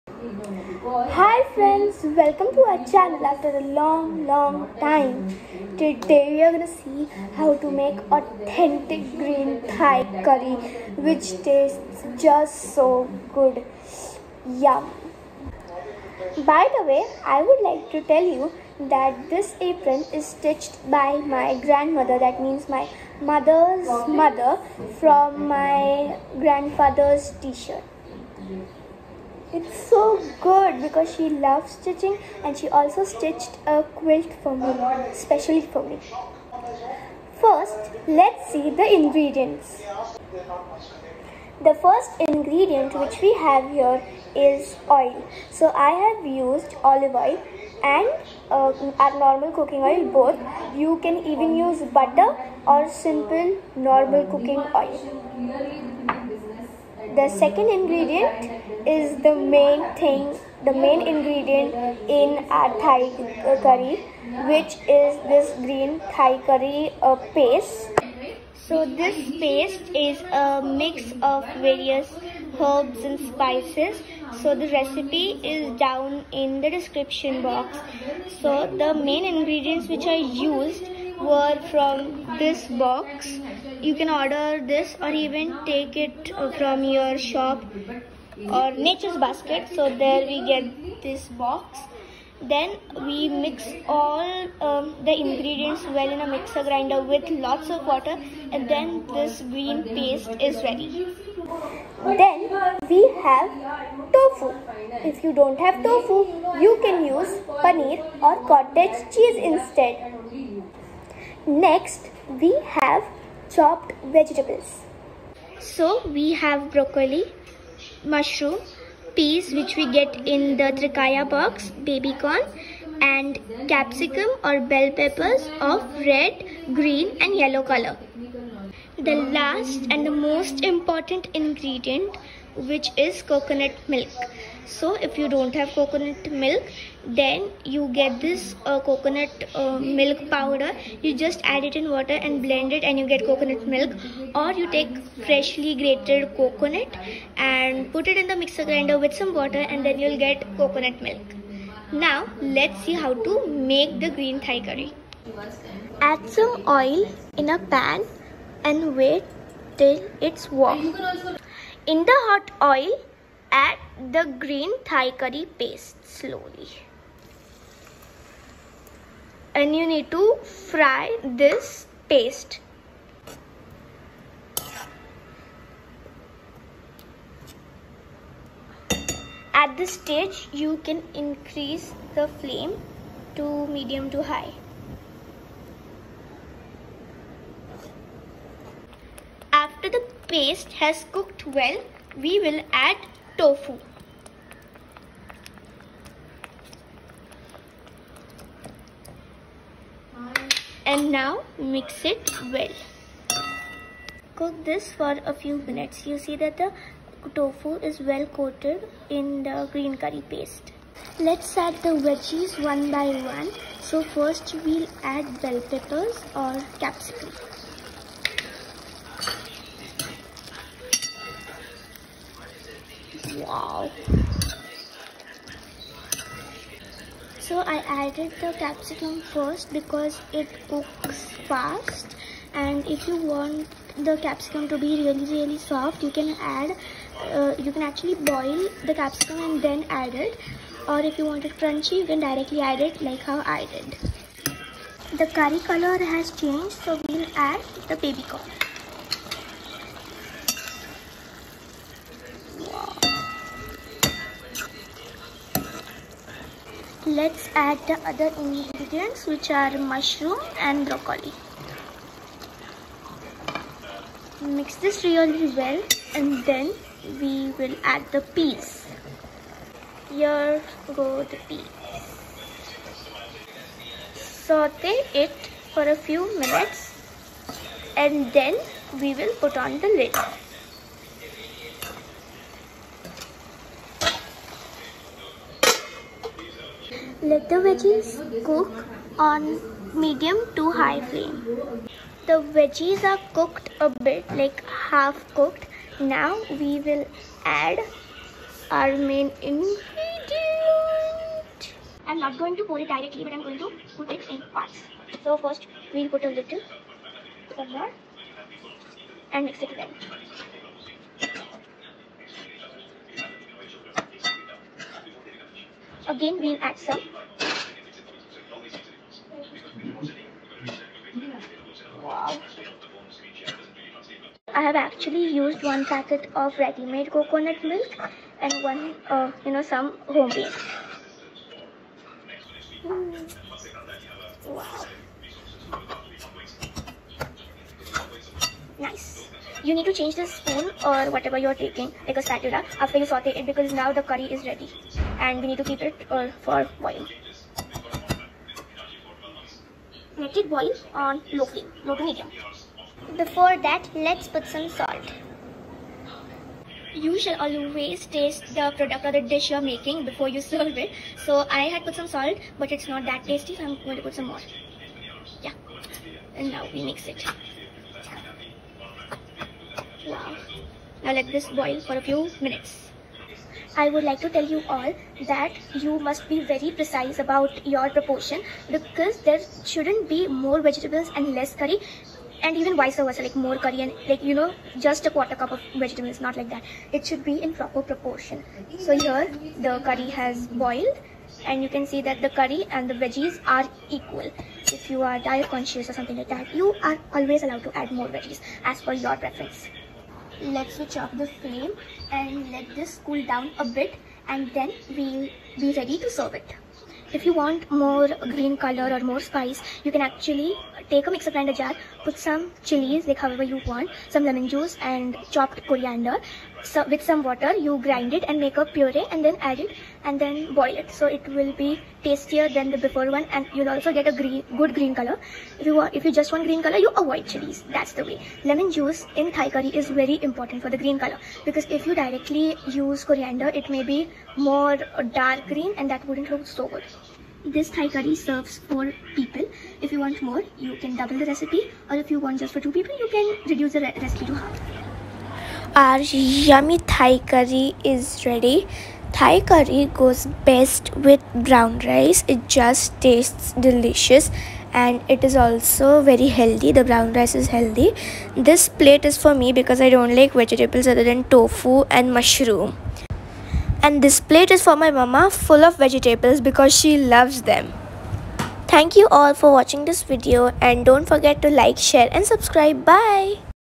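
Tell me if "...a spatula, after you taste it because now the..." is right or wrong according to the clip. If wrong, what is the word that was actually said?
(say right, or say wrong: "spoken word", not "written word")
wrong: "saute", not "taste".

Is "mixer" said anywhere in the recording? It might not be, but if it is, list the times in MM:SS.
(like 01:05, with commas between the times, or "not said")
01:36, 02:28, 06:51.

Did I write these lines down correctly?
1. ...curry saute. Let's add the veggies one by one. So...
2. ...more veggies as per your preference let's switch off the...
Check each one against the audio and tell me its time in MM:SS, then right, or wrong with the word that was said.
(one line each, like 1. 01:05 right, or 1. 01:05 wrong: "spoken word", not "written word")
1. 03:30 wrong: "paste", not "saute"
2. 06:38 right.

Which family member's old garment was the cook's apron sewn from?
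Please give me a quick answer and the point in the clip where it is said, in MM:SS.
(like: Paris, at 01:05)
Grandfather, at 00:25.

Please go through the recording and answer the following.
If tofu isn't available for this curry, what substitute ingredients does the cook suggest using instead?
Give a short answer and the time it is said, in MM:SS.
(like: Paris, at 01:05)
Paneer or cottage cheese, at 01:47.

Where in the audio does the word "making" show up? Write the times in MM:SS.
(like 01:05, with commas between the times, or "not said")
05:59.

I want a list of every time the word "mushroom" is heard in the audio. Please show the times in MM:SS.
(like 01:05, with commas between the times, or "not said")
01:58, 04:19, 07:42.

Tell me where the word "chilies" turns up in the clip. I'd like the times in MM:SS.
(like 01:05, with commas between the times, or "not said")
06:52, 07:07.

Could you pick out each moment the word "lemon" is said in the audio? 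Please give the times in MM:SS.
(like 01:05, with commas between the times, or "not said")
06:54, 07:08.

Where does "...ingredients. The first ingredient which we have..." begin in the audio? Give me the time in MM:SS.
00:38.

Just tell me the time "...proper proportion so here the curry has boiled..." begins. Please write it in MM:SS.
06:27.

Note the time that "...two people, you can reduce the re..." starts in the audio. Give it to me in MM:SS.
07:22.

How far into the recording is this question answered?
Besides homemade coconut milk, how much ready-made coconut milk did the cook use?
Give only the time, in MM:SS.
05:25.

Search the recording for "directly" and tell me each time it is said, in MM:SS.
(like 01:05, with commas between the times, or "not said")
04:02, 05:02, 07:11.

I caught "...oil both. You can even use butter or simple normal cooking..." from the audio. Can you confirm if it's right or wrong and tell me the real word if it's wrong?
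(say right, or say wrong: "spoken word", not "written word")
right.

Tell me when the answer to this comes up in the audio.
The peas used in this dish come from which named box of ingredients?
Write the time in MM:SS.
02:00.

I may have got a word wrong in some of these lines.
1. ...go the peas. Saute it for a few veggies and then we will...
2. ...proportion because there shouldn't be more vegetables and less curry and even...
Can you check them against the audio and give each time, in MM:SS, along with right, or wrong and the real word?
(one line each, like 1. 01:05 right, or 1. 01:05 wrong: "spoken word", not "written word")
1. 04:30 wrong: "minutes", not "veggies"
2. 06:17 right.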